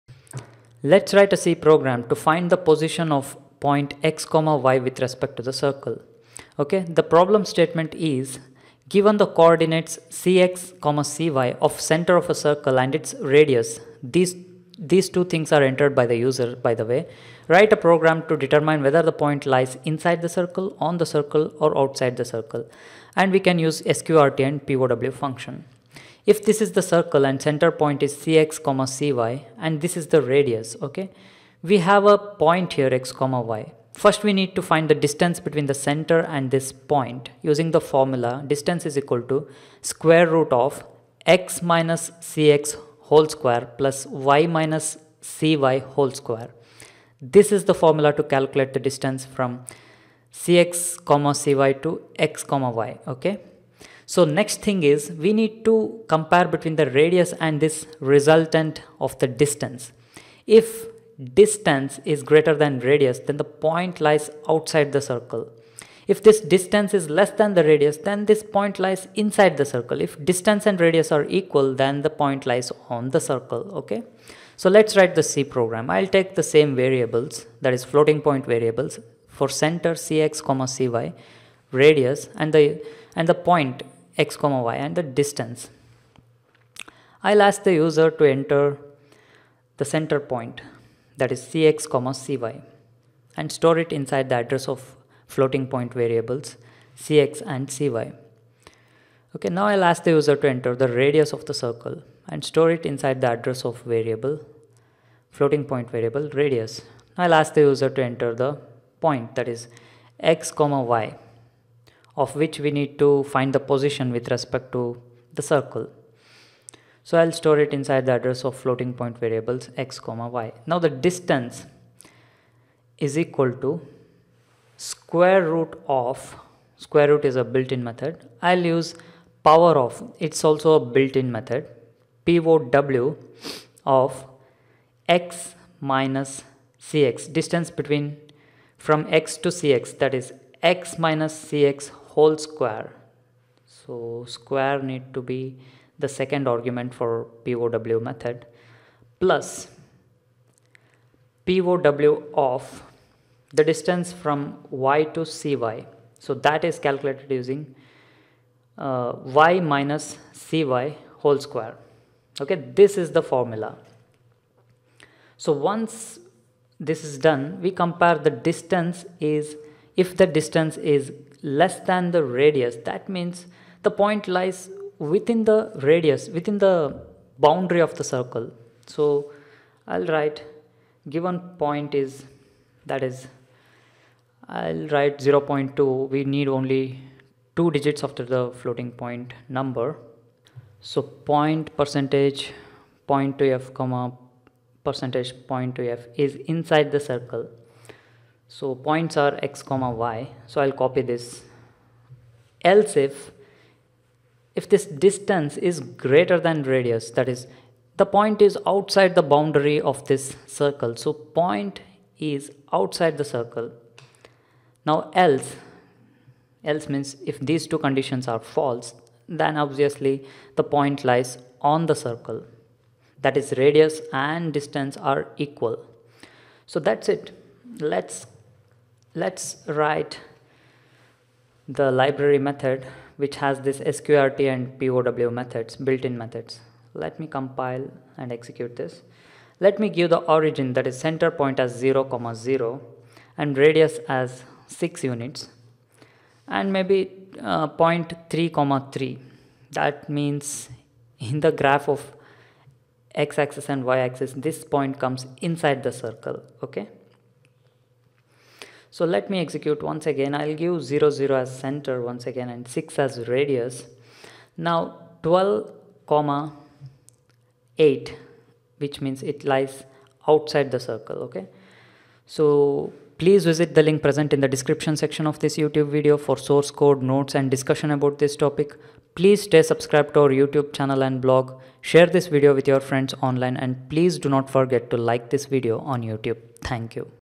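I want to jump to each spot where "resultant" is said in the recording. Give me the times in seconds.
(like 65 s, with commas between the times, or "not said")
57 s.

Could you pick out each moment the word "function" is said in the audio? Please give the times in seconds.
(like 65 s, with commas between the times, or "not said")
25 s.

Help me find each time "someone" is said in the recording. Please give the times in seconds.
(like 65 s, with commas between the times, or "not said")
not said.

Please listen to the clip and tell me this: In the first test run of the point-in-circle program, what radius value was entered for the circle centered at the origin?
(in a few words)
6.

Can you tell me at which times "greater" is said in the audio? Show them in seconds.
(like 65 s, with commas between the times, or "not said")
62 s, 206 s.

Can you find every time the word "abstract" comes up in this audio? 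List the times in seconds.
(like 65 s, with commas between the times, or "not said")
not said.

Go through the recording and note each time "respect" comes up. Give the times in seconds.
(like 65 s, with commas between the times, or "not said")
4 s, 114 s.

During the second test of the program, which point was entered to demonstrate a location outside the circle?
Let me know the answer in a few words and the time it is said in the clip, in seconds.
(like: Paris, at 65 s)
12, 8, at 265 s.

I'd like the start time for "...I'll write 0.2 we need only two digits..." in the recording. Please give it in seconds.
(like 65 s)
184 s.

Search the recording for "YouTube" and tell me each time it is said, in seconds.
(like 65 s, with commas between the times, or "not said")
275 s, 280 s, 286 s.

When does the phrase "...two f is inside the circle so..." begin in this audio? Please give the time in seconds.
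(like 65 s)
195 s.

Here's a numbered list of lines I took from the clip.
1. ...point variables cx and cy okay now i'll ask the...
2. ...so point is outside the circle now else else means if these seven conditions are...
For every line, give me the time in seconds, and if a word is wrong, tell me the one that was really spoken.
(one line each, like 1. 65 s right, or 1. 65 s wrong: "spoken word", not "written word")
1. 95 s right
2. 211 s wrong: "two", not "seven".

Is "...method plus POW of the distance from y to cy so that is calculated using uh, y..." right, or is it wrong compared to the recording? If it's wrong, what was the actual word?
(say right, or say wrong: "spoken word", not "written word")
right.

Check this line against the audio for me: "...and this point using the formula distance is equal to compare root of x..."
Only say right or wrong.
wrong.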